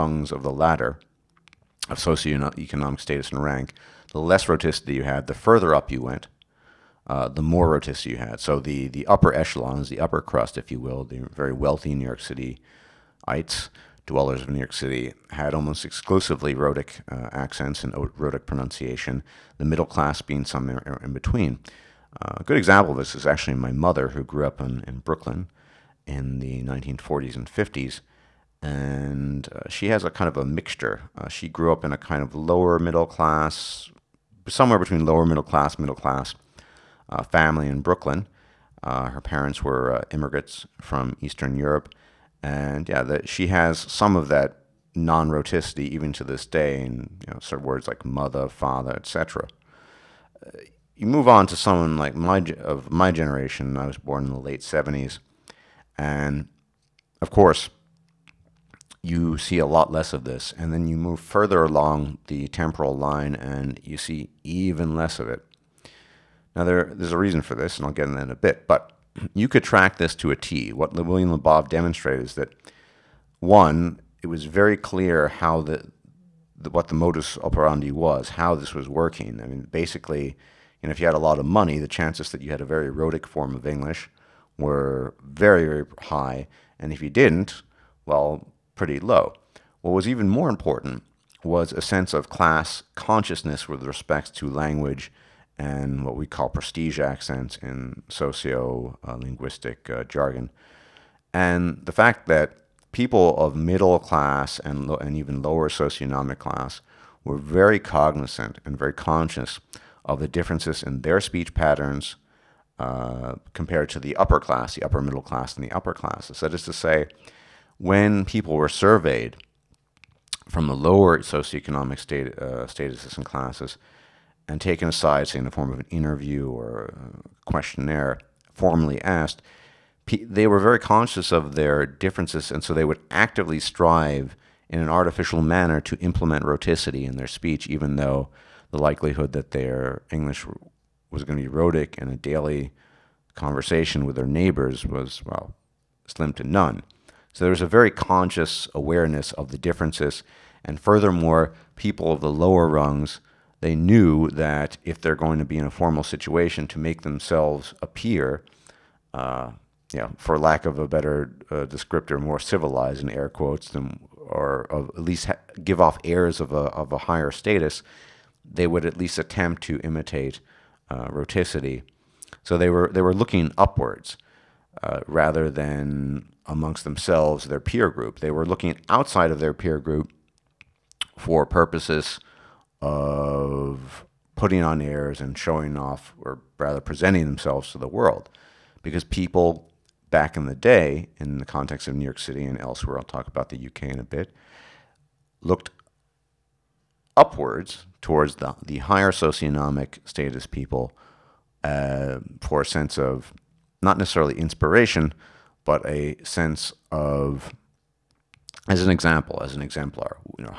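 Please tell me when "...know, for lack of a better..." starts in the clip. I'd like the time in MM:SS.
02:39.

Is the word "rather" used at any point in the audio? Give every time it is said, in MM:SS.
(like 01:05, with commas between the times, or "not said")
02:55, 03:06.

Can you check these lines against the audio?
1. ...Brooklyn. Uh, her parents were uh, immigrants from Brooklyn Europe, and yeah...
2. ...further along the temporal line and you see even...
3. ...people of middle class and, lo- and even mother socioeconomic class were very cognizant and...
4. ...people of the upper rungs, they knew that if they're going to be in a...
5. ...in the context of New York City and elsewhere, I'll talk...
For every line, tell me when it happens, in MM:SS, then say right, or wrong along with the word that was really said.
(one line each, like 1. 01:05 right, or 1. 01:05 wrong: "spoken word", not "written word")
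1. 00:37 wrong: "Eastern", not "Brooklyn"
2. 01:01 right
3. 01:42 wrong: "lower", not "mother"
4. 02:31 wrong: "lower", not "upper"
5. 03:11 right.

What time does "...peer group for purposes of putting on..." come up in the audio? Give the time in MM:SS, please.
02:59.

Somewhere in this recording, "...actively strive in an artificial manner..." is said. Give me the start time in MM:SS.
02:13.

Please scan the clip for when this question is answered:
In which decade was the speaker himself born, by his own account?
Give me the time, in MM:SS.
00:54.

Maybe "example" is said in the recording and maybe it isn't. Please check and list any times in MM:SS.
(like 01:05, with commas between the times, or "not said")
00:22, 03:28.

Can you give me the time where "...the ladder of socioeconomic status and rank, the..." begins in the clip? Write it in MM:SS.
00:00.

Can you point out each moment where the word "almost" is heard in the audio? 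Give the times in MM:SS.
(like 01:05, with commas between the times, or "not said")
00:15.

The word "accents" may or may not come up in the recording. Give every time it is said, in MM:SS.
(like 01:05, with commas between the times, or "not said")
00:17, 01:36.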